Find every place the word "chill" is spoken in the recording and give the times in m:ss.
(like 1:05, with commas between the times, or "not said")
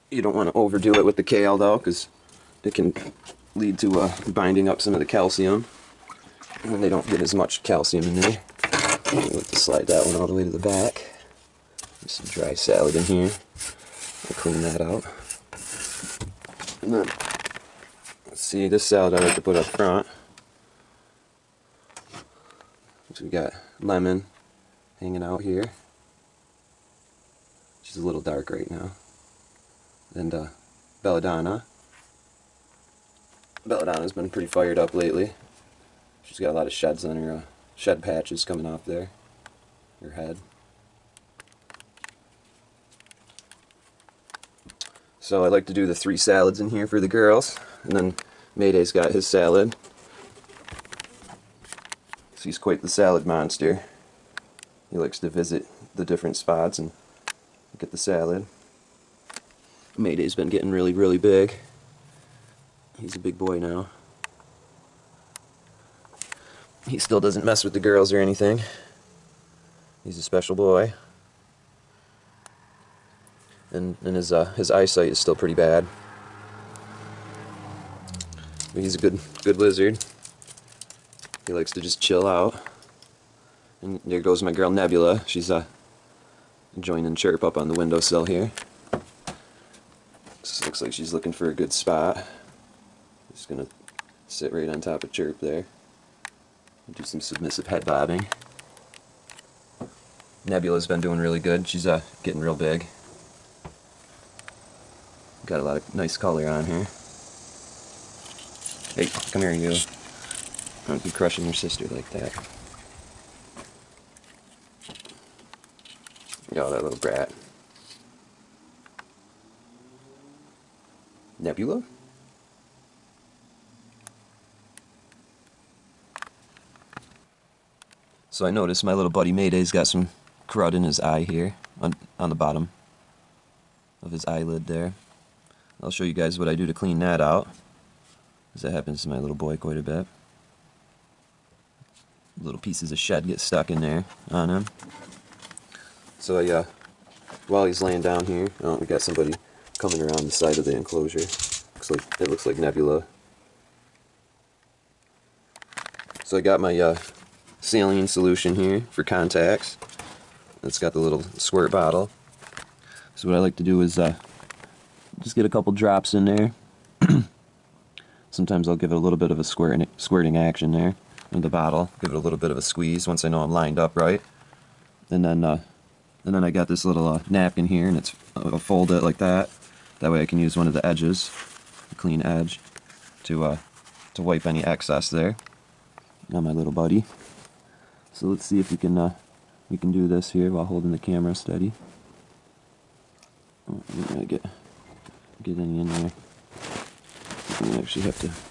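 1:21.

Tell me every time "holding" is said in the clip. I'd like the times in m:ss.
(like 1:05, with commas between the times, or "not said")
3:10.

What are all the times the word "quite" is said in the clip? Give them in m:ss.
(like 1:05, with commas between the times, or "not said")
0:52, 2:19.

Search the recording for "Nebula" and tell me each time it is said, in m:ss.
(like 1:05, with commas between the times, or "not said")
1:24, 1:40, 2:01, 2:32.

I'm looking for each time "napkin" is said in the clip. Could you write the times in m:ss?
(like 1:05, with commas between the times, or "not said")
2:57.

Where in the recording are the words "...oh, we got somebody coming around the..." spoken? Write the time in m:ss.
2:28.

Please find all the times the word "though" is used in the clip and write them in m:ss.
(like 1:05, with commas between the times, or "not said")
0:01.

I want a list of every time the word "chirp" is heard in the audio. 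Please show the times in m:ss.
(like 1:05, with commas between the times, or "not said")
1:27, 1:35.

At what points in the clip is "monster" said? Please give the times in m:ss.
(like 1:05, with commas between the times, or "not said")
0:53.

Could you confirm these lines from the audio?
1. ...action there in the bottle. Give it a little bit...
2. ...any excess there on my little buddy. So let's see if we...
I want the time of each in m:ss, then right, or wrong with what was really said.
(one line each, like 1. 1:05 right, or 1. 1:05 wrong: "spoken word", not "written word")
1. 2:50 right
2. 3:04 right.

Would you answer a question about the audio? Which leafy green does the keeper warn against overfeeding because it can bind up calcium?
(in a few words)
Kale.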